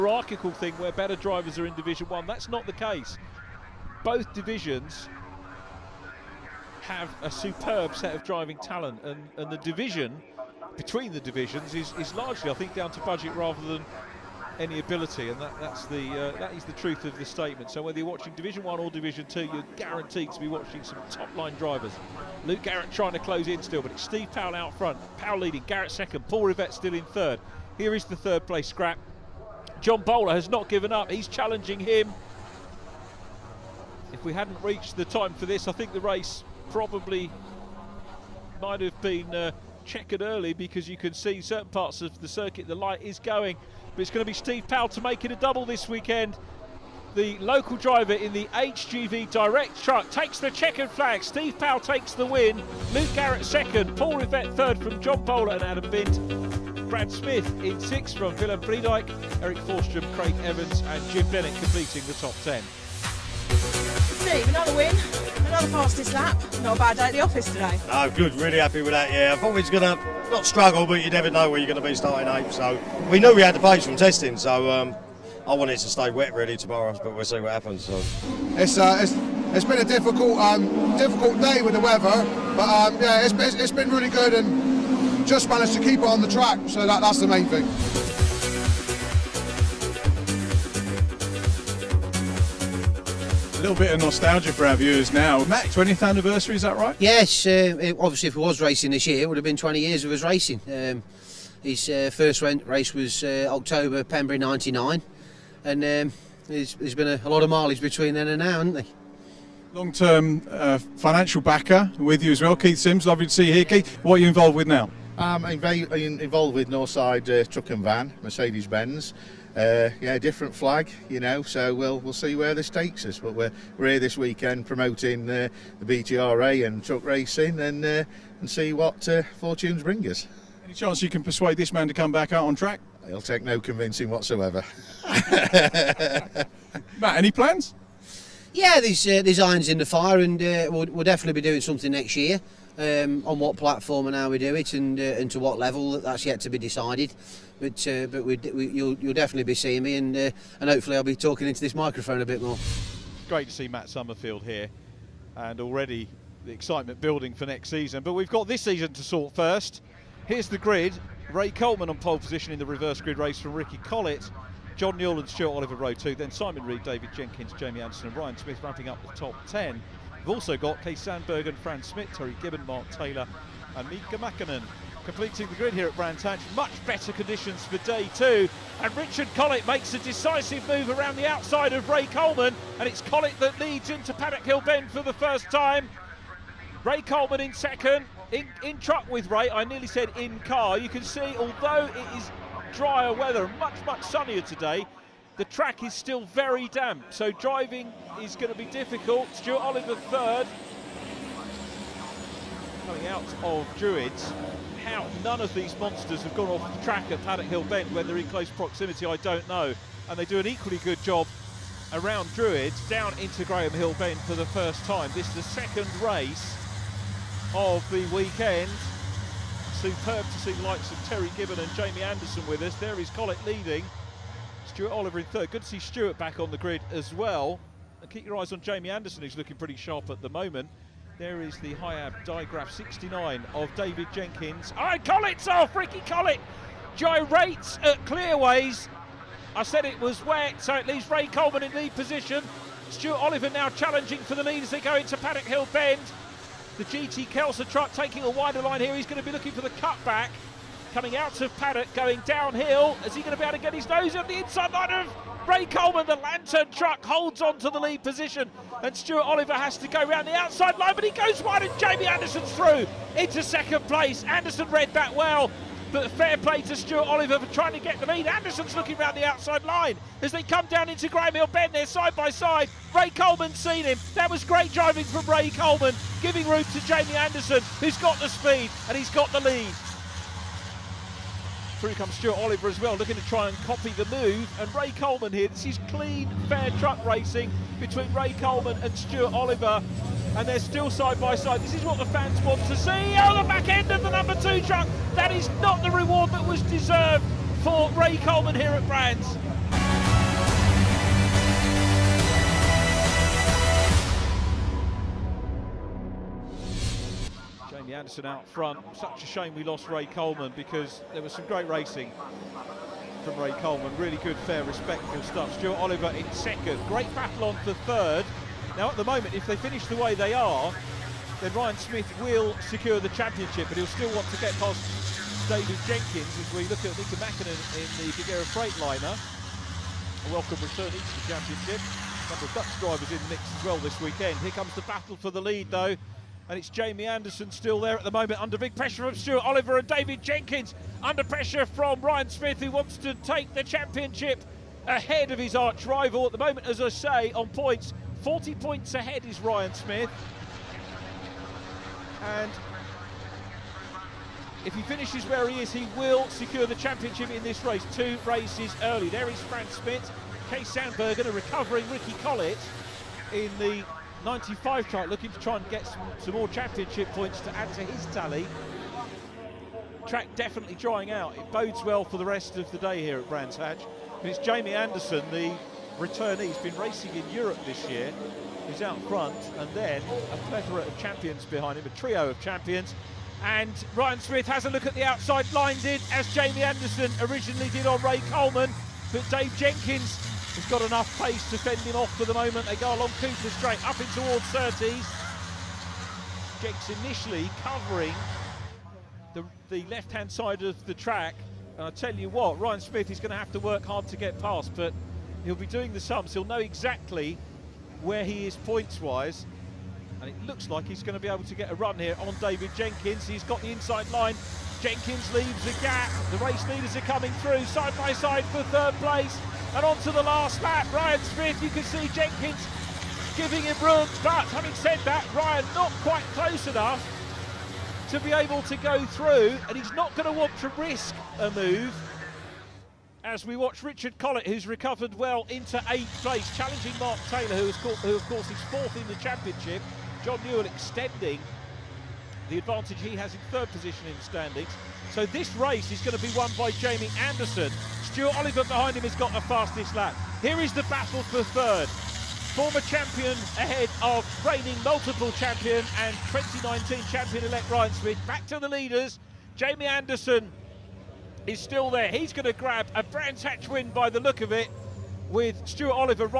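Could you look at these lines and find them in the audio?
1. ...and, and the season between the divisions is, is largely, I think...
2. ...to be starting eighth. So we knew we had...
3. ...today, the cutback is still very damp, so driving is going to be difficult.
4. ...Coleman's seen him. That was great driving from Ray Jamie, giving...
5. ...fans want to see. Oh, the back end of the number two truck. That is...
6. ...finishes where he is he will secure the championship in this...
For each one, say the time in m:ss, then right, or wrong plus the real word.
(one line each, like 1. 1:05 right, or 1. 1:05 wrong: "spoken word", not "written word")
1. 0:09 wrong: "division", not "season"
2. 1:11 right
3. 3:14 wrong: "track", not "cutback"
4. 4:33 wrong: "Coleman", not "Jamie"
5. 4:52 right
6. 5:54 right.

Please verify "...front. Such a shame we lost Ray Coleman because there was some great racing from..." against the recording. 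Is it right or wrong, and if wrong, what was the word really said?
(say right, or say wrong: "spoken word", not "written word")
right.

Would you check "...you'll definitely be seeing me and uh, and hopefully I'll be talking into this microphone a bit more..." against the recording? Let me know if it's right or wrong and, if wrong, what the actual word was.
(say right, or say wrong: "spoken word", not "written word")
right.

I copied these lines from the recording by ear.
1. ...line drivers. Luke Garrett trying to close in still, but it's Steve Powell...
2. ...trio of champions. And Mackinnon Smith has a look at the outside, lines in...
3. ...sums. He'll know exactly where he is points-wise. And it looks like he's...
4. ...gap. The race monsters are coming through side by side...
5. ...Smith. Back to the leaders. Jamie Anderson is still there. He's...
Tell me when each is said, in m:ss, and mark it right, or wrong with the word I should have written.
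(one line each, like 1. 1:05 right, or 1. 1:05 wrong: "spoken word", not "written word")
1. 0:21 right
2. 6:21 wrong: "Ryan", not "Mackinnon"
3. 6:45 right
4. 6:55 wrong: "leaders", not "monsters"
5. 7:37 right.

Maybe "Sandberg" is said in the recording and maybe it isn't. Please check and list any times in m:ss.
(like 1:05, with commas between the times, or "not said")
2:50, 6:00.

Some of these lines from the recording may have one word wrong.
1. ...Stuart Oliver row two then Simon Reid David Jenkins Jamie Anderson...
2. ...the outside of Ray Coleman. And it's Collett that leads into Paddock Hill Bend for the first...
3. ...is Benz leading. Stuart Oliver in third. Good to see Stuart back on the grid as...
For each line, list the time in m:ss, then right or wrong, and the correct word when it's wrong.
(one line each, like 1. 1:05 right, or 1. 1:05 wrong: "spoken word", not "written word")
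1. 2:45 right
2. 3:01 right
3. 3:42 wrong: "Collett", not "Benz".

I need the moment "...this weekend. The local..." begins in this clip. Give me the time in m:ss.
0:45.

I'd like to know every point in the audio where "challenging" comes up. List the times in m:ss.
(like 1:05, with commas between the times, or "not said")
0:31, 4:03, 7:16.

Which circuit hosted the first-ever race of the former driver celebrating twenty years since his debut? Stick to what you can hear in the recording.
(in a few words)
Pembrey.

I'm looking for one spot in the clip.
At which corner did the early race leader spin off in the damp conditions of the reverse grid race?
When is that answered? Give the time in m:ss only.
3:58.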